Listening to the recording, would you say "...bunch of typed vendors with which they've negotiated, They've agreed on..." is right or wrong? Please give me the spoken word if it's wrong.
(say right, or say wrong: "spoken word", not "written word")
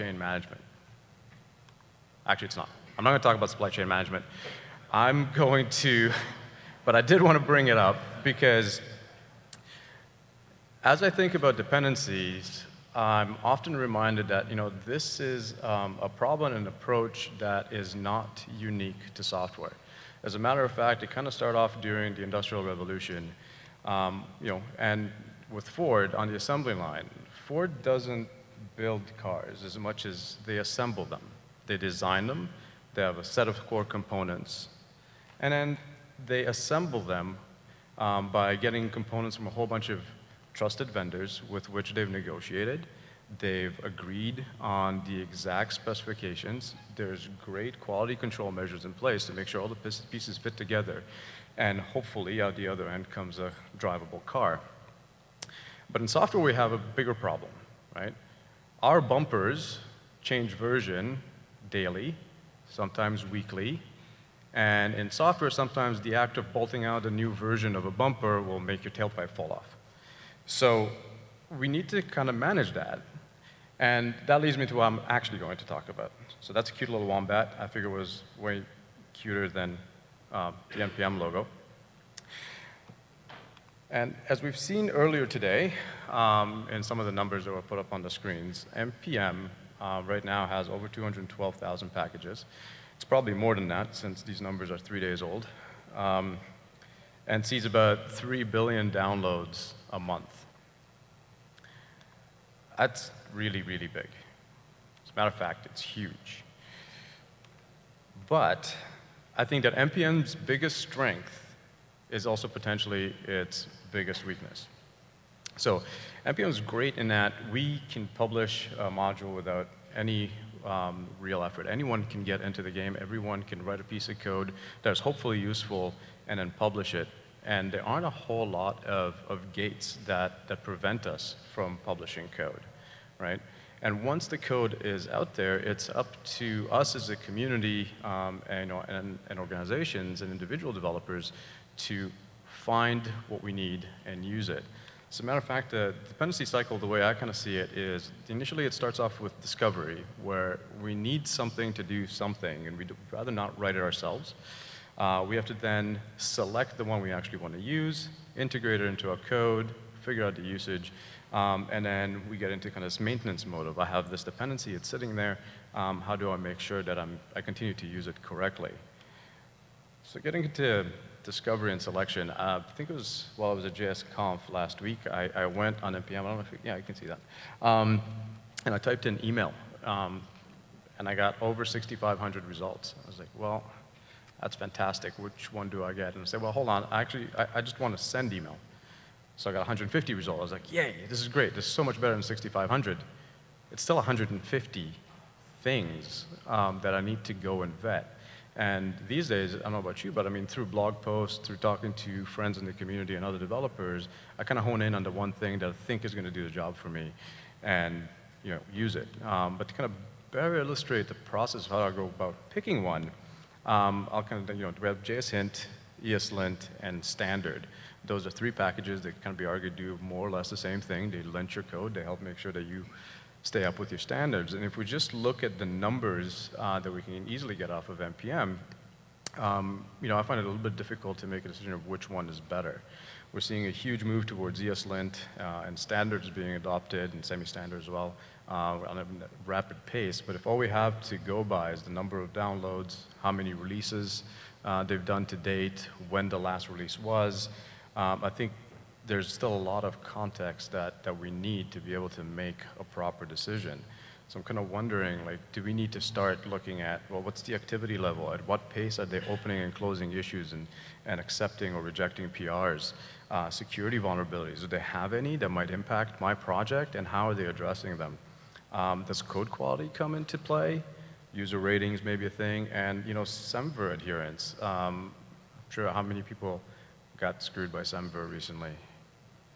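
wrong: "trusted", not "typed".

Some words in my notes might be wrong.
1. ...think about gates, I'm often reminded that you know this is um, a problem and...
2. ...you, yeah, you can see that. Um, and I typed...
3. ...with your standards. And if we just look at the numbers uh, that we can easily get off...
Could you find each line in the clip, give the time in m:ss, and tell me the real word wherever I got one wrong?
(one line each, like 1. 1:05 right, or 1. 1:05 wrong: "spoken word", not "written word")
1. 0:11 wrong: "dependencies", not "gates"
2. 2:56 right
3. 3:43 right.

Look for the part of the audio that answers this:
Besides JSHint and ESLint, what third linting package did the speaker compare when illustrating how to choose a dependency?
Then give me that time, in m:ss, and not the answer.
3:37.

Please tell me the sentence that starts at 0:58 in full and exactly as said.
Our bumpers change version daily, sometimes weekly.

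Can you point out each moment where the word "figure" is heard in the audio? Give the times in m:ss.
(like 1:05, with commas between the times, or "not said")
1:17, 2:40.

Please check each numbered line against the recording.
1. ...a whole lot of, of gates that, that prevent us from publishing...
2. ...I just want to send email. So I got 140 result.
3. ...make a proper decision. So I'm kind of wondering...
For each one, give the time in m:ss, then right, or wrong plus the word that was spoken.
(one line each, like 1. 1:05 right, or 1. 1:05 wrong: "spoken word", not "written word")
1. 2:08 right
2. 3:07 wrong: "150", not "140"
3. 4:12 right.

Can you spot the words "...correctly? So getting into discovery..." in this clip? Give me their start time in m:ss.
2:48.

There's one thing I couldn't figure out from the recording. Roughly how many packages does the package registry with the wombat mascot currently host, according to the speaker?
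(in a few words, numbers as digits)
212,000.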